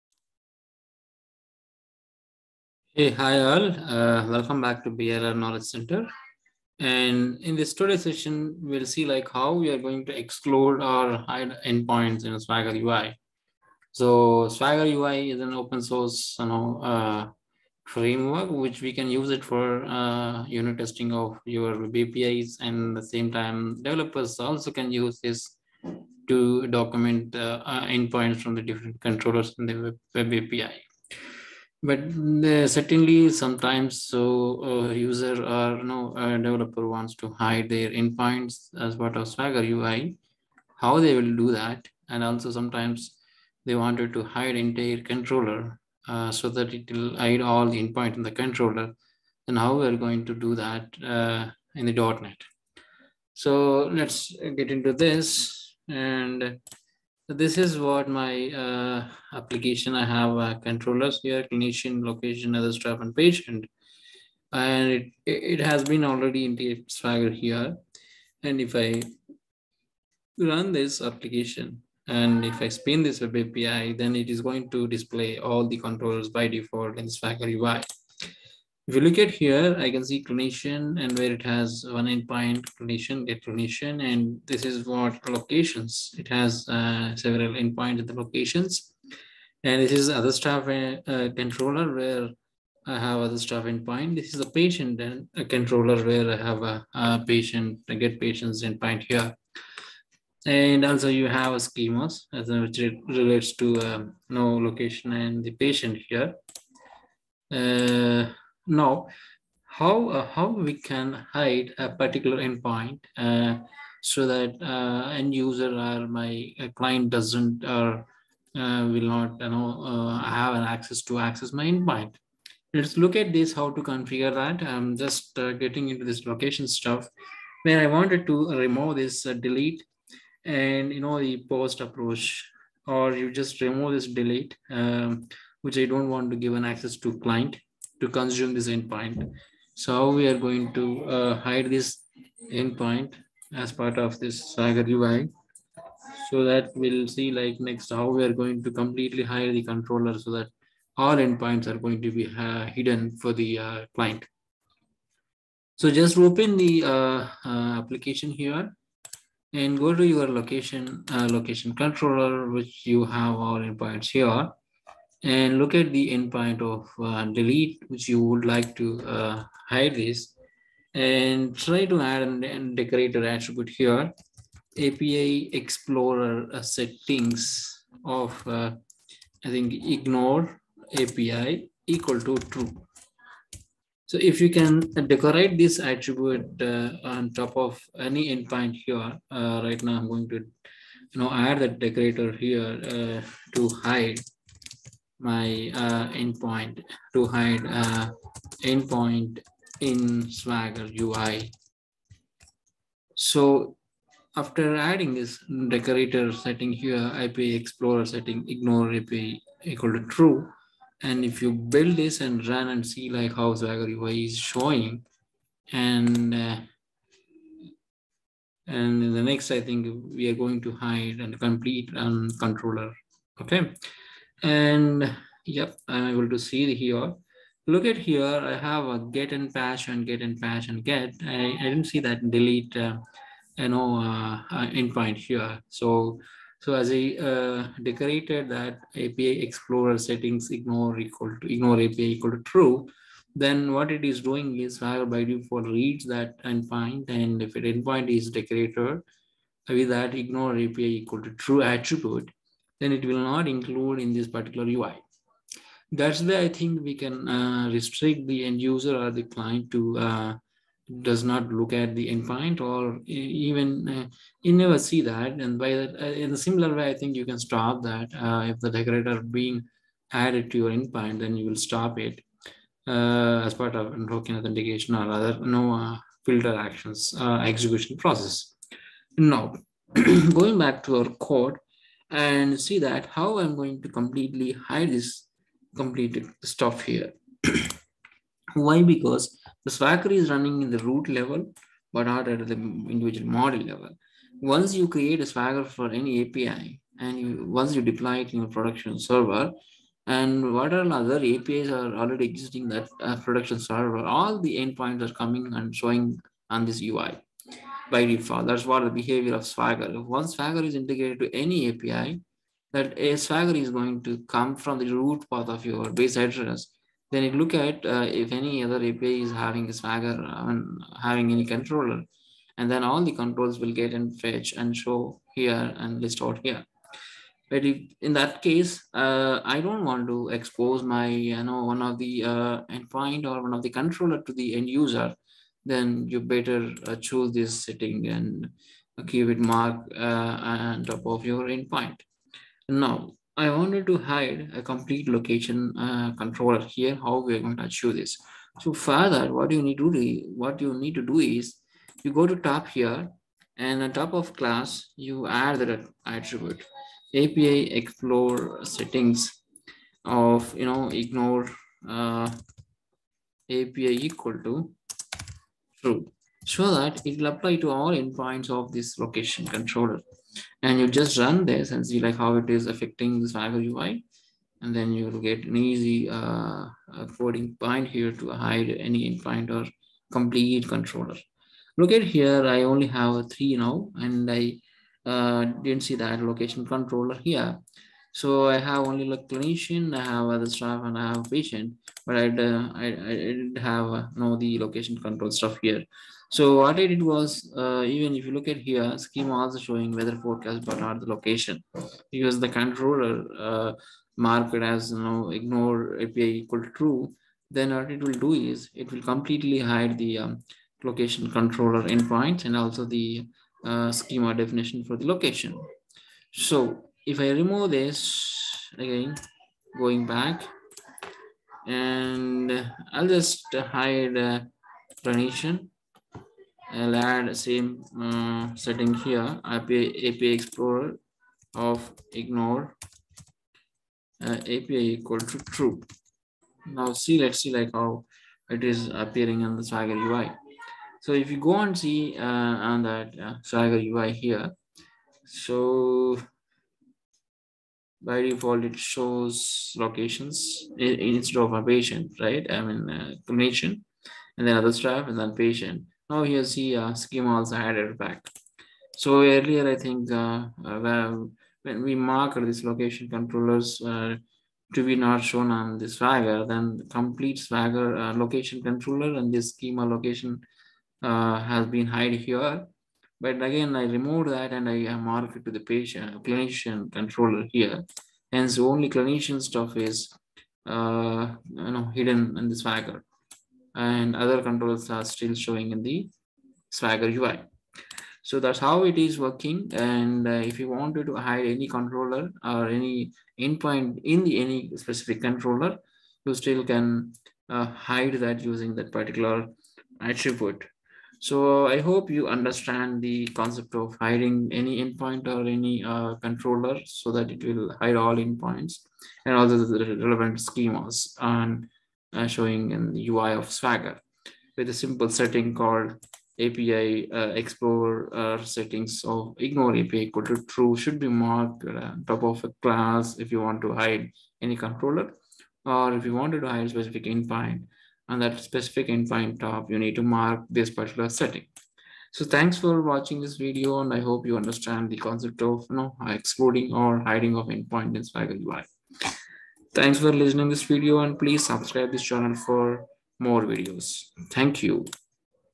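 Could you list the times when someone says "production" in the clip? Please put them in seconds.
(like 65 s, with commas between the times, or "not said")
298 s, 303 s.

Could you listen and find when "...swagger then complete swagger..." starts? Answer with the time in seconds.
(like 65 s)
465 s.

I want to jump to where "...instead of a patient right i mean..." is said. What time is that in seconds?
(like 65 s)
450 s.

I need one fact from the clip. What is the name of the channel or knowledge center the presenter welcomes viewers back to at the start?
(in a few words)
BRR Knowledge Center.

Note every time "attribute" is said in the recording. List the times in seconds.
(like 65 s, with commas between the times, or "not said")
173 s, 185 s, 251 s, 356 s, 500 s.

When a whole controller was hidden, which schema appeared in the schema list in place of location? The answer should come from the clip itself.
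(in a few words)
weather forecast.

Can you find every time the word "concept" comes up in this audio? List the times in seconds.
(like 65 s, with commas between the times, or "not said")
503 s, 534 s.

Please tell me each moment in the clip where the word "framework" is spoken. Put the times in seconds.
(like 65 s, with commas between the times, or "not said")
17 s.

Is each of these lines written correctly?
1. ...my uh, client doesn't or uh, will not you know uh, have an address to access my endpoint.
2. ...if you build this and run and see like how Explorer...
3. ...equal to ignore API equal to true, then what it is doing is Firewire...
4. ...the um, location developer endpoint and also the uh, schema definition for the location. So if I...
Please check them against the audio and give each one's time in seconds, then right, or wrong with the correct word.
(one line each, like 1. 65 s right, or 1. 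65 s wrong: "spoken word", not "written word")
1. 116 s wrong: "access", not "address"
2. 211 s wrong: "Swagger", not "Explorer"
3. 240 s right
4. 409 s wrong: "controller", not "developer".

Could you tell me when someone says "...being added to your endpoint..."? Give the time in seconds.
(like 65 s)
269 s.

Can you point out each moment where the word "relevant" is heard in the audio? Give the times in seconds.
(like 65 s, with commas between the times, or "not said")
509 s.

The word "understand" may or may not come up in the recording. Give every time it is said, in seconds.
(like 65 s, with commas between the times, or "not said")
502 s, 534 s.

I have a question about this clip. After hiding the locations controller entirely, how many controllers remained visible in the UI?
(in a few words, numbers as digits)
3.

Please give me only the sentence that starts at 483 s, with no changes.
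And other controllers are still showing in the Swagger UI.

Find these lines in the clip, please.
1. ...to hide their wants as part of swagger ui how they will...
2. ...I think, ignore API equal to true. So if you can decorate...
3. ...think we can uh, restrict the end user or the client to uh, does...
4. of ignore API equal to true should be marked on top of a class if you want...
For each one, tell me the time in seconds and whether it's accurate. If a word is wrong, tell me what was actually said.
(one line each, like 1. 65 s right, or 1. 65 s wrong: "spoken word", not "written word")
1. 37 s wrong: "endpoints", not "wants"
2. 179 s right
3. 256 s right
4. 519 s right.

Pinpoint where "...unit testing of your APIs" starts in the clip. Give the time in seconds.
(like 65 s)
20 s.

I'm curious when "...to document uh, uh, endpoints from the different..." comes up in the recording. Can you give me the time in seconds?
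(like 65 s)
26 s.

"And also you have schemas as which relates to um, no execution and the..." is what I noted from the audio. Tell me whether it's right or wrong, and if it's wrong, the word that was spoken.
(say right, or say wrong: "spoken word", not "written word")
wrong: "location", not "execution".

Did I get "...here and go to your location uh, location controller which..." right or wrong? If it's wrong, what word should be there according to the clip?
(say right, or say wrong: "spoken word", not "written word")
right.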